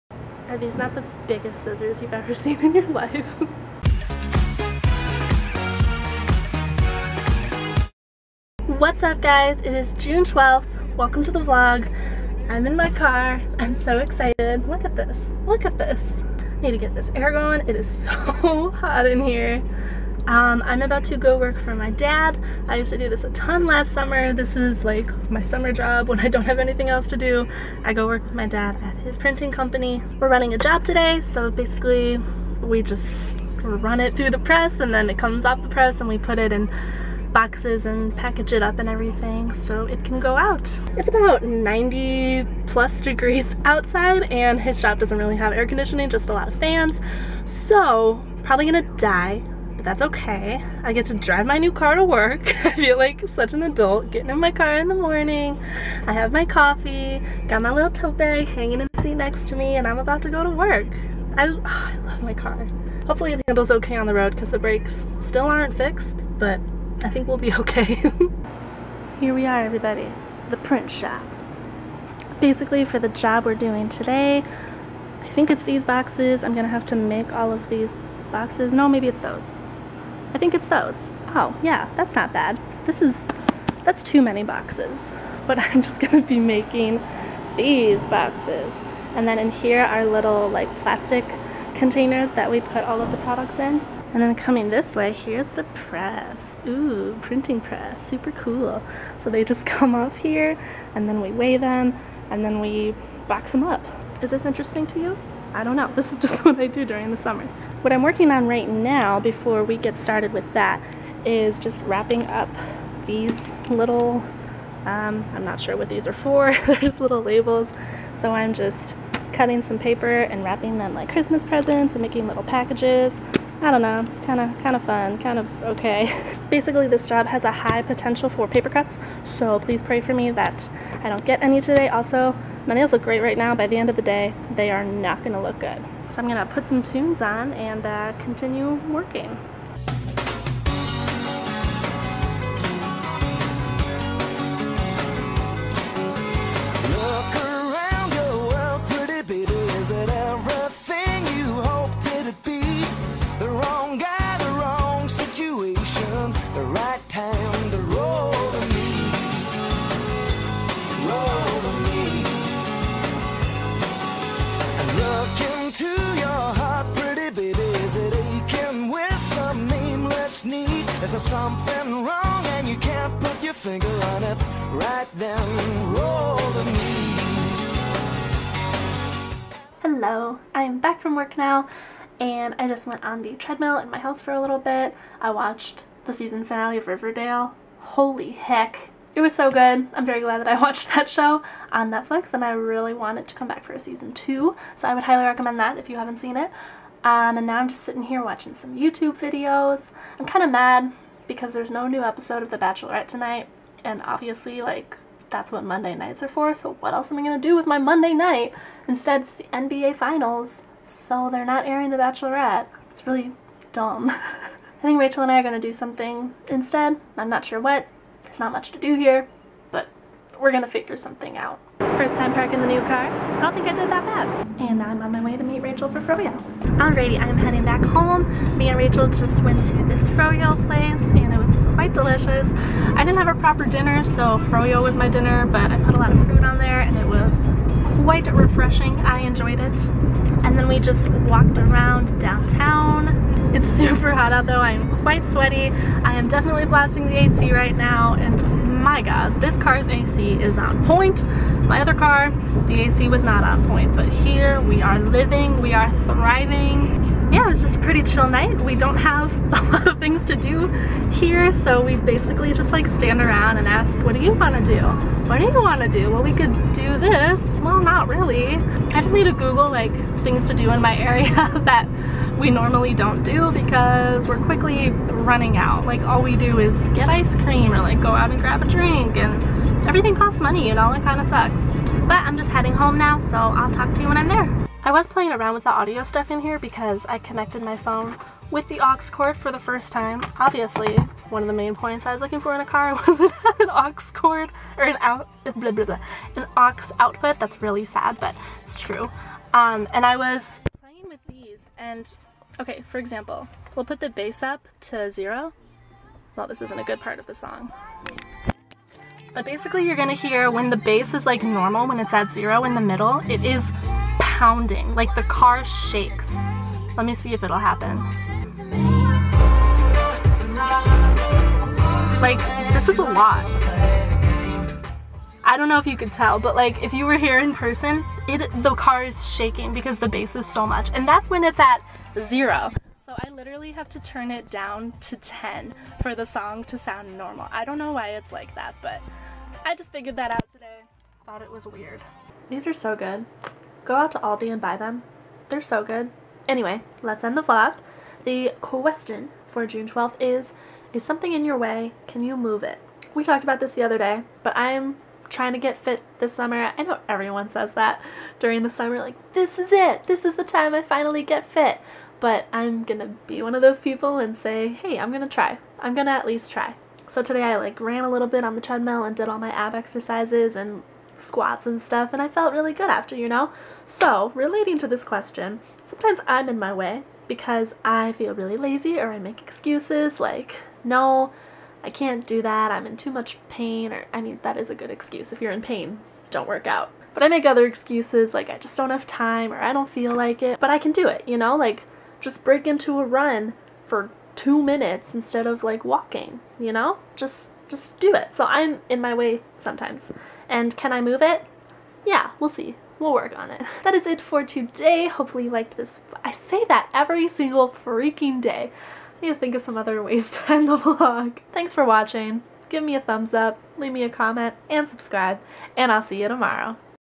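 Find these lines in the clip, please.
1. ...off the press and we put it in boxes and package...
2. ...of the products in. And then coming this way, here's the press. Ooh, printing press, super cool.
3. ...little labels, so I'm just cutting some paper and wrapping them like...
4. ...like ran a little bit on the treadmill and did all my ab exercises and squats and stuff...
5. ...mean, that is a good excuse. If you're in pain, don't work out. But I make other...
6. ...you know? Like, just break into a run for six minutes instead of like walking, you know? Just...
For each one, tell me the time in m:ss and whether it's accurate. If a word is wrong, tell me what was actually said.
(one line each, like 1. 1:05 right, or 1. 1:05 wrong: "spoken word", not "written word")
1. 0:35 right
2. 1:33 right
3. 1:56 right
4. 6:07 right
5. 6:24 right
6. 6:31 wrong: "two", not "six".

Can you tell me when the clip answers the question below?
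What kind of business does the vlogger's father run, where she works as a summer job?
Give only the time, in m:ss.
0:29.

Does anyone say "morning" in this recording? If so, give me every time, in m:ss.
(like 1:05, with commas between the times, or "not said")
0:54.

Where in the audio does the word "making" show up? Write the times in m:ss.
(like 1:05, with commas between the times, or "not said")
1:26, 2:02.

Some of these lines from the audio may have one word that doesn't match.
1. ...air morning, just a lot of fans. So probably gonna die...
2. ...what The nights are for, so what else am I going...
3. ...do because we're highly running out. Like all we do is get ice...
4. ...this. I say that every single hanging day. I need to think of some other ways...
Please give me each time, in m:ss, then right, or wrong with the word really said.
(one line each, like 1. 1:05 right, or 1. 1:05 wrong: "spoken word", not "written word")
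1. 0:45 wrong: "conditioning", not "morning"
2. 3:25 wrong: "Monday", not "The"
3. 4:33 wrong: "quickly", not "highly"
4. 6:45 wrong: "freaking", not "hanging".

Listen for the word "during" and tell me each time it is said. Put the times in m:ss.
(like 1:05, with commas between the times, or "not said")
1:46, 5:58.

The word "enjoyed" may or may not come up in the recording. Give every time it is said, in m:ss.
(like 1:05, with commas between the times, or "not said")
3:59.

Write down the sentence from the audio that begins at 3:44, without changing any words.
And I'm on my way to meet Rachel for Froyo.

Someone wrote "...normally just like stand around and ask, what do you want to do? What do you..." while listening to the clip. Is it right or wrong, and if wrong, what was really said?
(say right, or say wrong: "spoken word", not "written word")
wrong: "basically", not "normally".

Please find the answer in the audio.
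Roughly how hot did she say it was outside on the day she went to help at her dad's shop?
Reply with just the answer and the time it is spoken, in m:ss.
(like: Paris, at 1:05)
90 plus degrees, at 0:41.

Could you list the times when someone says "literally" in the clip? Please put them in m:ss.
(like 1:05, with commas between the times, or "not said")
5:33.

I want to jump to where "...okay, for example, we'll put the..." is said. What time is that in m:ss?
5:02.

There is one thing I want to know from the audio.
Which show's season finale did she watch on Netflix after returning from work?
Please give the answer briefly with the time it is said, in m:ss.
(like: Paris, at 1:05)
Riverdale, at 3:06.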